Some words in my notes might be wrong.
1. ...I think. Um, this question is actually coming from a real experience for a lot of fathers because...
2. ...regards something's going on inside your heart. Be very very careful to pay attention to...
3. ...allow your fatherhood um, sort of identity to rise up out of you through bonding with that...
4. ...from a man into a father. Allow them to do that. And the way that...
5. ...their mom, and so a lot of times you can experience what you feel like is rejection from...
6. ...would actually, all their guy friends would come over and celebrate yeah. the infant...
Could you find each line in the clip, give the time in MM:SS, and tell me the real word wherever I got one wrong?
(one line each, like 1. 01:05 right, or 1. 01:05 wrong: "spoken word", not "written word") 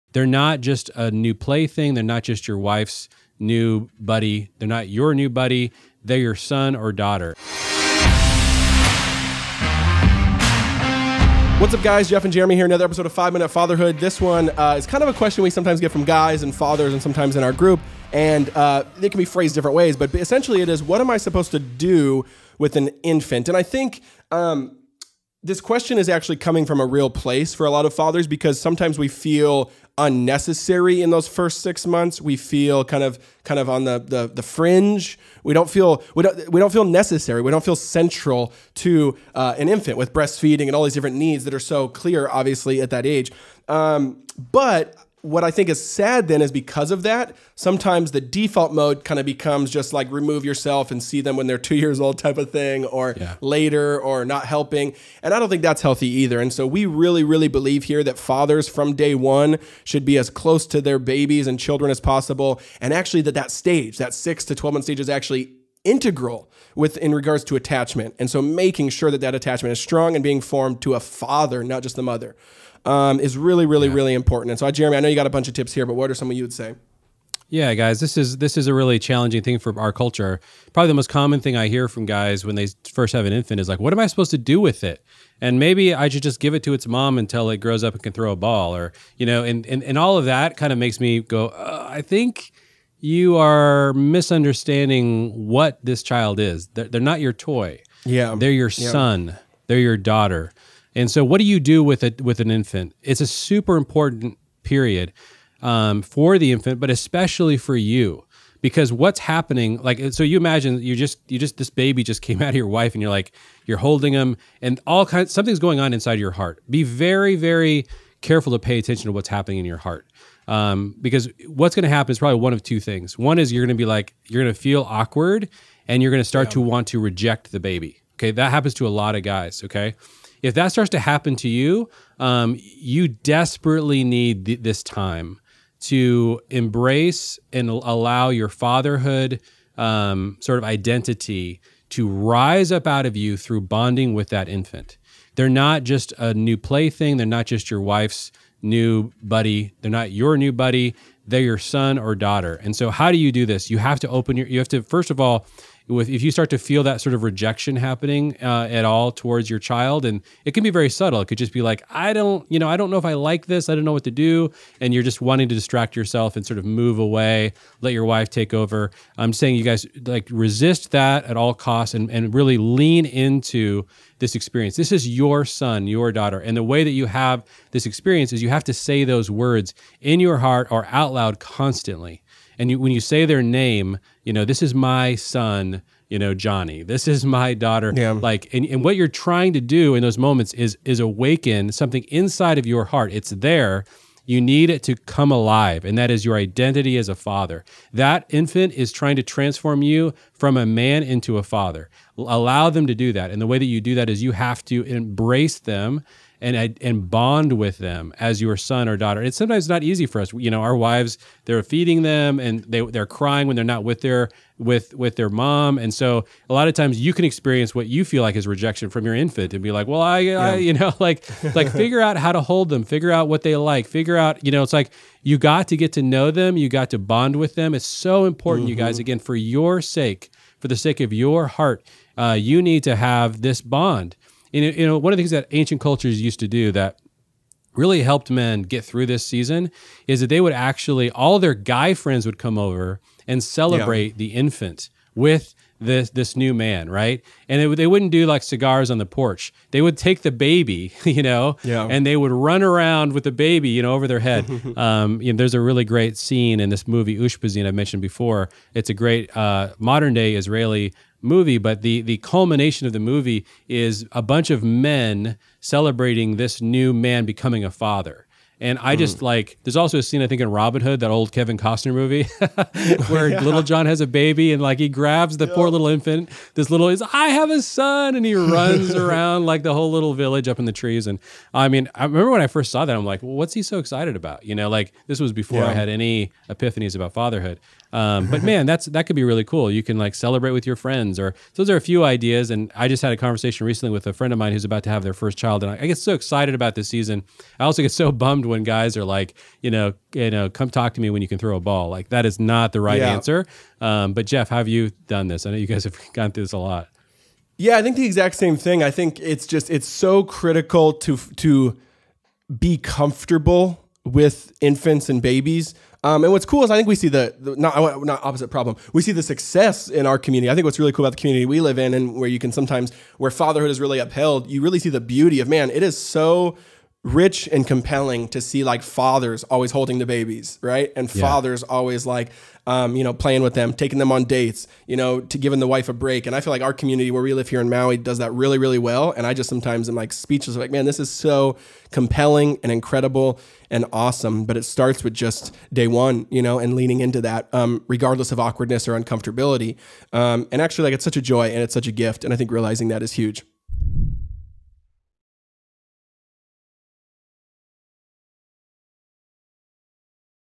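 1. 00:23 wrong: "place", not "experience"
2. 01:55 wrong: "kinds", not "regards"
3. 02:17 right
4. 03:20 right
5. 03:35 right
6. 04:00 right.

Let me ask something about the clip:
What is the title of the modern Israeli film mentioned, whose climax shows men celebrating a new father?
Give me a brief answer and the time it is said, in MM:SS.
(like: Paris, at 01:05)
Ushpizin, at 04:17.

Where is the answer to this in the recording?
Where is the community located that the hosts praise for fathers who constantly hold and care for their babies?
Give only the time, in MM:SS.
05:37.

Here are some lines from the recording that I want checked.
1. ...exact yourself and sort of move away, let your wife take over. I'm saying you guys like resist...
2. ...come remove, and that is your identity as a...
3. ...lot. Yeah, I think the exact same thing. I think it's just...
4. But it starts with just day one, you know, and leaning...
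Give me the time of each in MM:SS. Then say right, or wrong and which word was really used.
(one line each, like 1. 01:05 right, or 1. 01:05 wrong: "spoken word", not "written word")
1. 02:45 wrong: "distract", not "exact"
2. 03:14 wrong: "alive", not "remove"
3. 05:06 right
4. 05:44 right.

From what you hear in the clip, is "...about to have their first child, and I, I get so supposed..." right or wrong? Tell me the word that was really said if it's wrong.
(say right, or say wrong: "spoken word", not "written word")
wrong: "excited", not "supposed".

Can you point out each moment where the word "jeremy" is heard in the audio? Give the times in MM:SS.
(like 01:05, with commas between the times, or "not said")
00:12, 01:14.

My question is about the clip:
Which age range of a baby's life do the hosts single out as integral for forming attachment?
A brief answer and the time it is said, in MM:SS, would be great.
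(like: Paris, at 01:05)
6 to 12 months, at 01:04.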